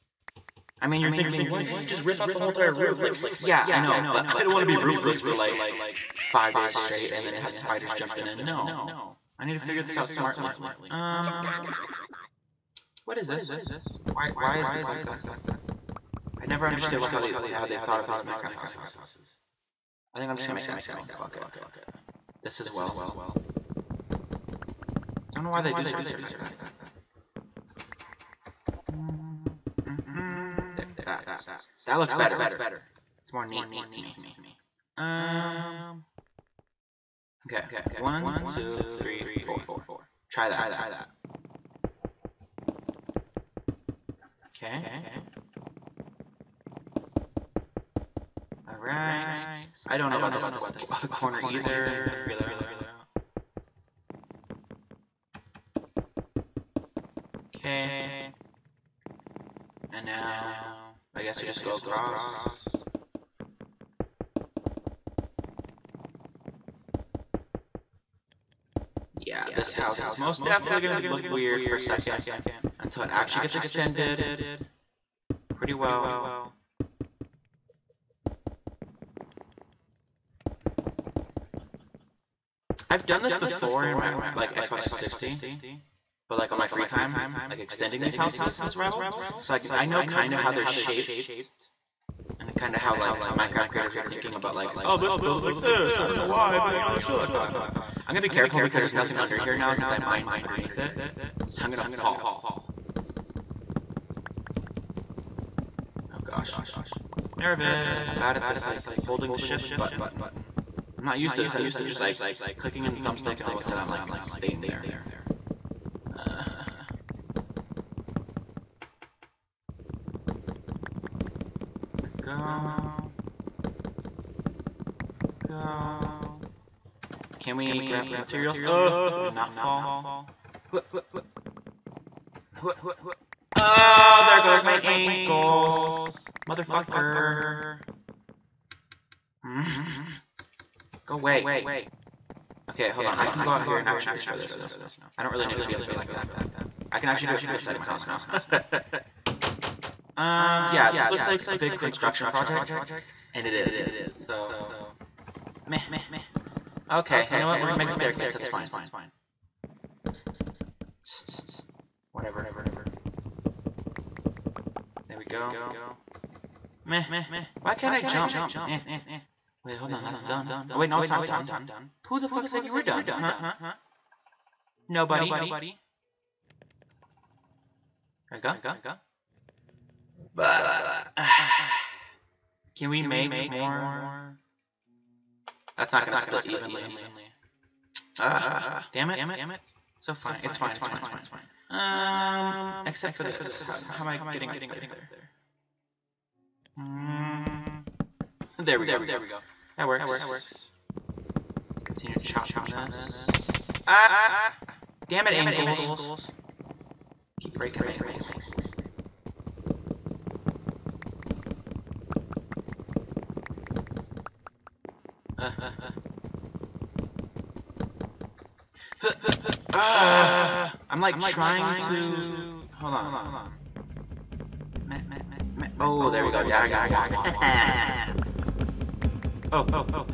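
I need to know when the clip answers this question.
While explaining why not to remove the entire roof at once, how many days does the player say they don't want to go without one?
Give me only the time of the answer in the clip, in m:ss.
0:06.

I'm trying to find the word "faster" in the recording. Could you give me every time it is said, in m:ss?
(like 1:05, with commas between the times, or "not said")
not said.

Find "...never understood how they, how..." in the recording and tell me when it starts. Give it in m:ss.
0:16.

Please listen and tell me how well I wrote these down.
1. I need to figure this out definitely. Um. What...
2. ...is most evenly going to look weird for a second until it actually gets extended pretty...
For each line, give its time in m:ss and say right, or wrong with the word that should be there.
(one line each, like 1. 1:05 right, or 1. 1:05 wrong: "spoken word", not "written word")
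1. 0:09 wrong: "smartly", not "definitely"
2. 1:10 wrong: "definitely", not "evenly".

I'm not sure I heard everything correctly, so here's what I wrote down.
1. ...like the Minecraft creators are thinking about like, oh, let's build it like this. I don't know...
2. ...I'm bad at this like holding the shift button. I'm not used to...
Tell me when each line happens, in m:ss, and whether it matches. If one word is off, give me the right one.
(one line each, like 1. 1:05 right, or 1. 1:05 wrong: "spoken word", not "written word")
1. 1:32 right
2. 1:48 right.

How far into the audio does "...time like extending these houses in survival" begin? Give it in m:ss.
1:26.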